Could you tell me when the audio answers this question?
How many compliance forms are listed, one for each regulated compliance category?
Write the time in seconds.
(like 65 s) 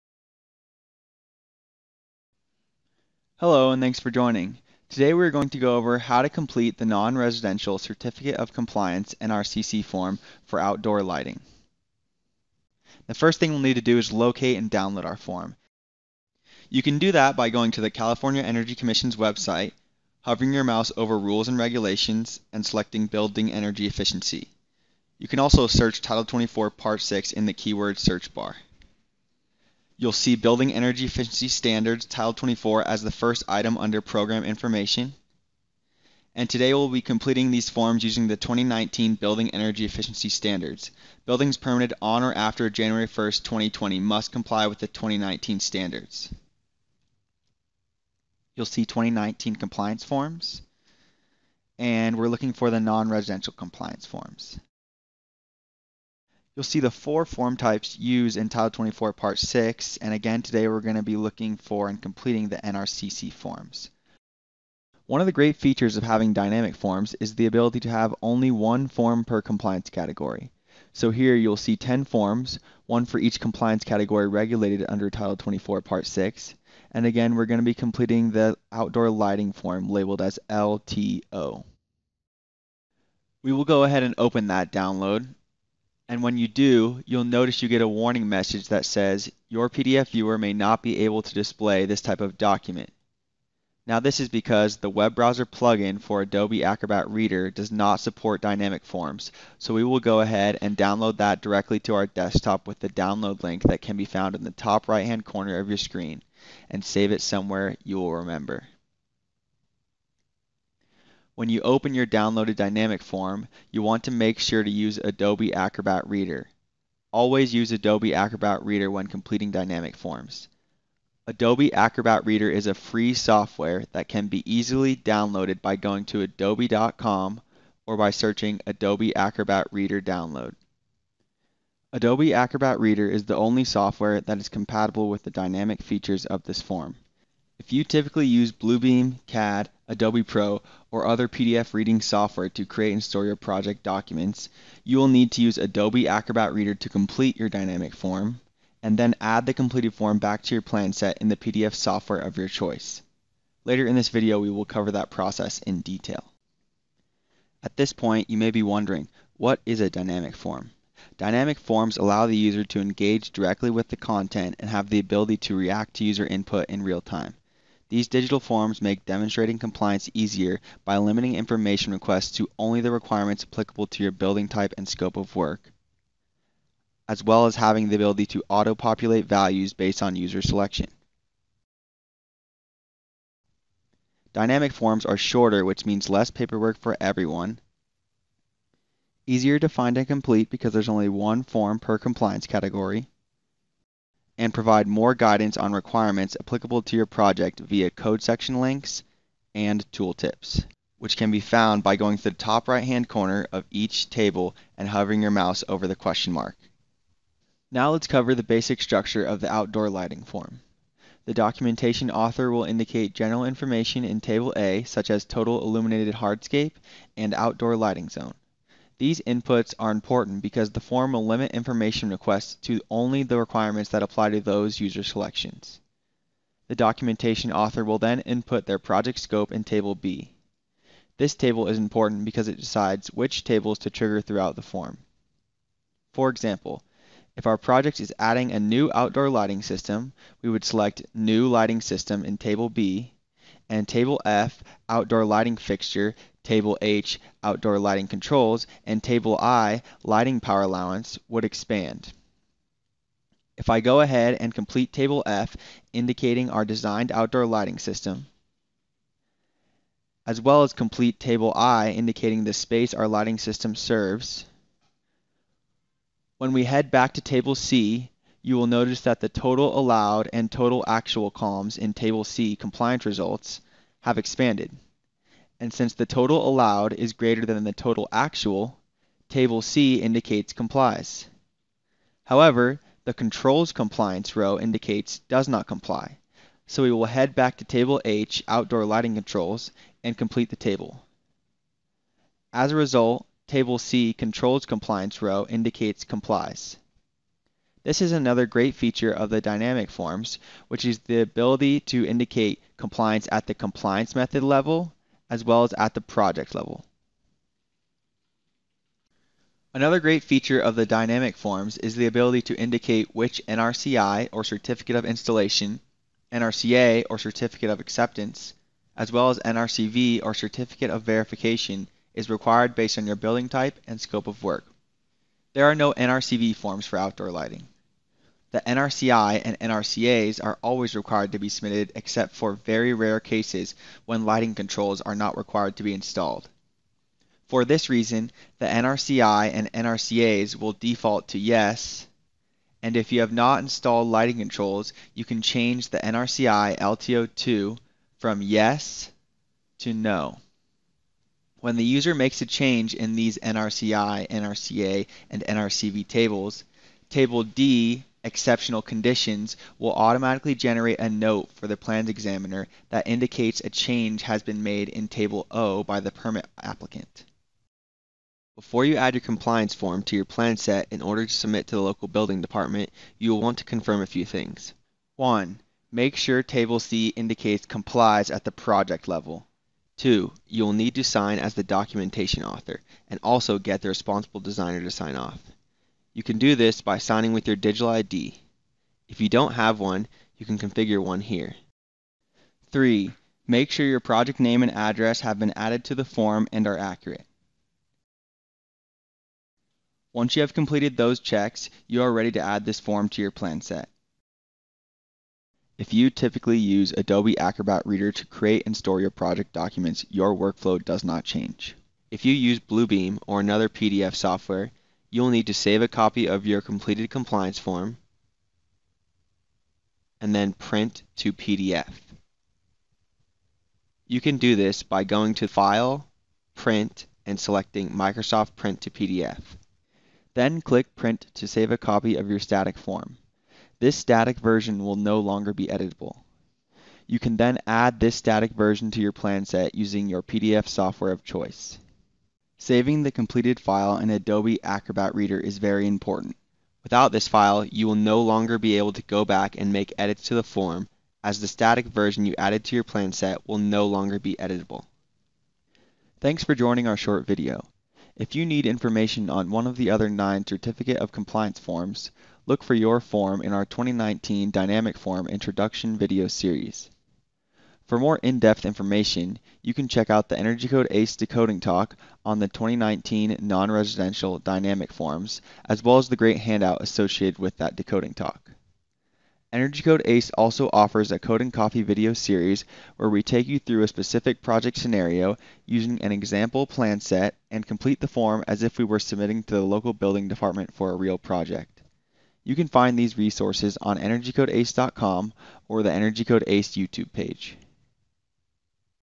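71 s.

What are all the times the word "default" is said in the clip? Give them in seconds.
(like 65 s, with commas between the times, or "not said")
340 s.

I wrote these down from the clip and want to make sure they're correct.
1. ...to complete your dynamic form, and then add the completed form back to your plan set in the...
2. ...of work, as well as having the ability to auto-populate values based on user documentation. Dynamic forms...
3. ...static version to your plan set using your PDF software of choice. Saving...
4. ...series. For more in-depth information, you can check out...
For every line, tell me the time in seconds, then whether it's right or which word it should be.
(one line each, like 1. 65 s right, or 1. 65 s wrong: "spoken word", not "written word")
1. 146 s right
2. 175 s wrong: "selection", not "documentation"
3. 438 s right
4. 466 s right.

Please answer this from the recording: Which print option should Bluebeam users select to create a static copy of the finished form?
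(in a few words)
Microsoft Print to PDF.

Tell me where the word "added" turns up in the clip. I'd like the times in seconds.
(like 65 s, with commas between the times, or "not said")
395 s, 452 s.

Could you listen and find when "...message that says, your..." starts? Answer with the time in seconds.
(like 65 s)
88 s.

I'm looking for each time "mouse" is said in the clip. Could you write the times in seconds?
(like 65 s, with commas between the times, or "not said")
20 s, 205 s.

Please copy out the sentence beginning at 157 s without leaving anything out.
At this point, you may be wondering, what is a dynamic form?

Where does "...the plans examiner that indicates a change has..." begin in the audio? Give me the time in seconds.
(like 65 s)
361 s.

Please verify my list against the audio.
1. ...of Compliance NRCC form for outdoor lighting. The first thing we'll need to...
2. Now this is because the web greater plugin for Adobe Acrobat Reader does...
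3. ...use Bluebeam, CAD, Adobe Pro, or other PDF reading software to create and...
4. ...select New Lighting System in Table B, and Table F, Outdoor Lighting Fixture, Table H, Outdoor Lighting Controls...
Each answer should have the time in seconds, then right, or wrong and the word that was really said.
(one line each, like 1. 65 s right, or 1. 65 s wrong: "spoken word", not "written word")
1. 8 s right
2. 93 s wrong: "browser", not "greater"
3. 138 s right
4. 240 s right.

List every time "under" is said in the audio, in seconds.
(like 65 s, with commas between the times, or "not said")
33 s, 74 s.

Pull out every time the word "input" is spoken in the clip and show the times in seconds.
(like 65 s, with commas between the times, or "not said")
166 s, 219 s, 228 s.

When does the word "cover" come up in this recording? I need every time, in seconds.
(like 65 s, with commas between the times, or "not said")
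154 s, 208 s.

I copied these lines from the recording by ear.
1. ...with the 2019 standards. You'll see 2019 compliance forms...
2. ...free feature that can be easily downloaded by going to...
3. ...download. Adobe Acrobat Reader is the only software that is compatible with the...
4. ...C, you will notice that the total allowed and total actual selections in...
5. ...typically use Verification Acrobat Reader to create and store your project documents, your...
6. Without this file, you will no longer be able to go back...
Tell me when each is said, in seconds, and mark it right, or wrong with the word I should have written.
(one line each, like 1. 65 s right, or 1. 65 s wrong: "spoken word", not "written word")
1. 44 s right
2. 122 s wrong: "software", not "feature"
3. 130 s right
4. 267 s wrong: "columns", not "selections"
5. 406 s wrong: "Adobe", not "Verification"
6. 446 s right.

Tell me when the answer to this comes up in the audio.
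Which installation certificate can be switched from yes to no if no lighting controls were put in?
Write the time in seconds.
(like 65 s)
345 s.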